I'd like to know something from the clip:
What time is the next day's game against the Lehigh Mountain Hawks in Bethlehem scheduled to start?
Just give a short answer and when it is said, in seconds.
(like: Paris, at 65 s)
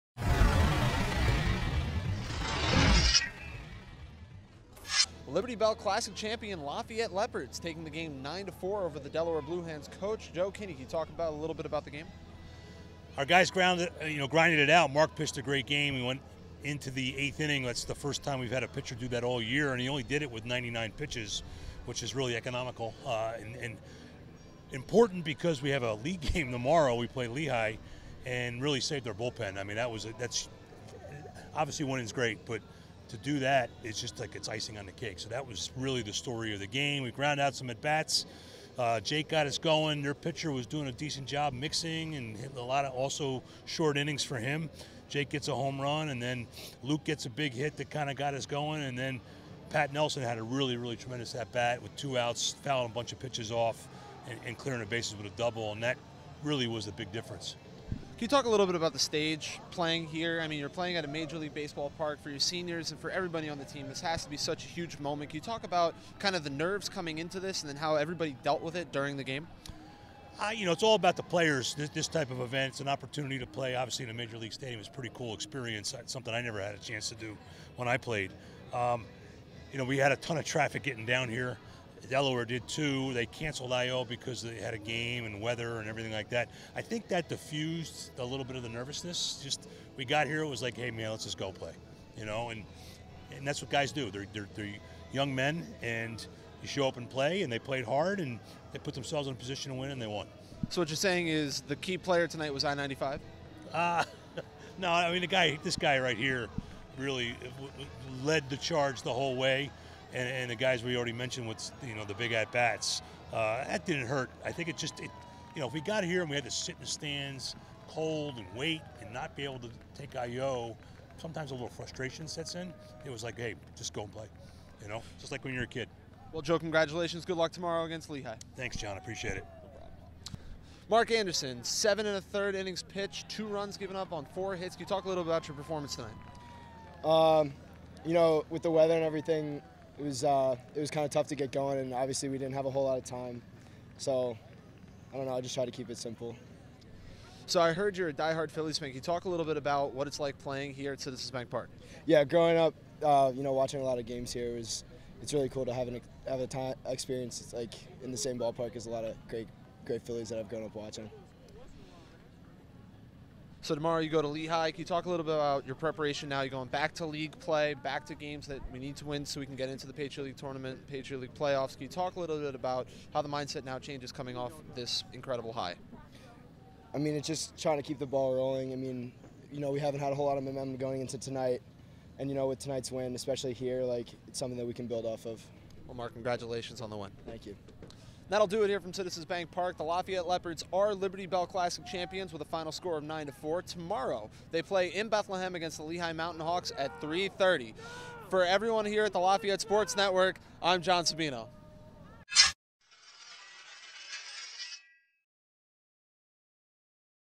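3:30, at 197 s.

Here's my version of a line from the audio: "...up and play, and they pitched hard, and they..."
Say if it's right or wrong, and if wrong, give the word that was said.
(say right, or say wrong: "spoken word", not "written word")
wrong: "played", not "pitched".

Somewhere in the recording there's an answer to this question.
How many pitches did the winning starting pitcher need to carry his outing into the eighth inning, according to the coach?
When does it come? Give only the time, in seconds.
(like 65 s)
20 s.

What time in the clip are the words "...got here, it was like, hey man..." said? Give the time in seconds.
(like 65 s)
90 s.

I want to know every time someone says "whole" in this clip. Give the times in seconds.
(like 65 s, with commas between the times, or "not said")
109 s, 142 s, 180 s.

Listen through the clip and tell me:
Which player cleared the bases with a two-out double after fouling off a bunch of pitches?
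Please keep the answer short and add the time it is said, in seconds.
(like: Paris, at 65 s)
Pat Nelson, at 49 s.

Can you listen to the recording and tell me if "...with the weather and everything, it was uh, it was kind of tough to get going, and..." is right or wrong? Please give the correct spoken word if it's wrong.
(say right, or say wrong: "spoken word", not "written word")
right.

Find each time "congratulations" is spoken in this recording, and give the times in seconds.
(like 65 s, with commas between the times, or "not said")
126 s, 186 s.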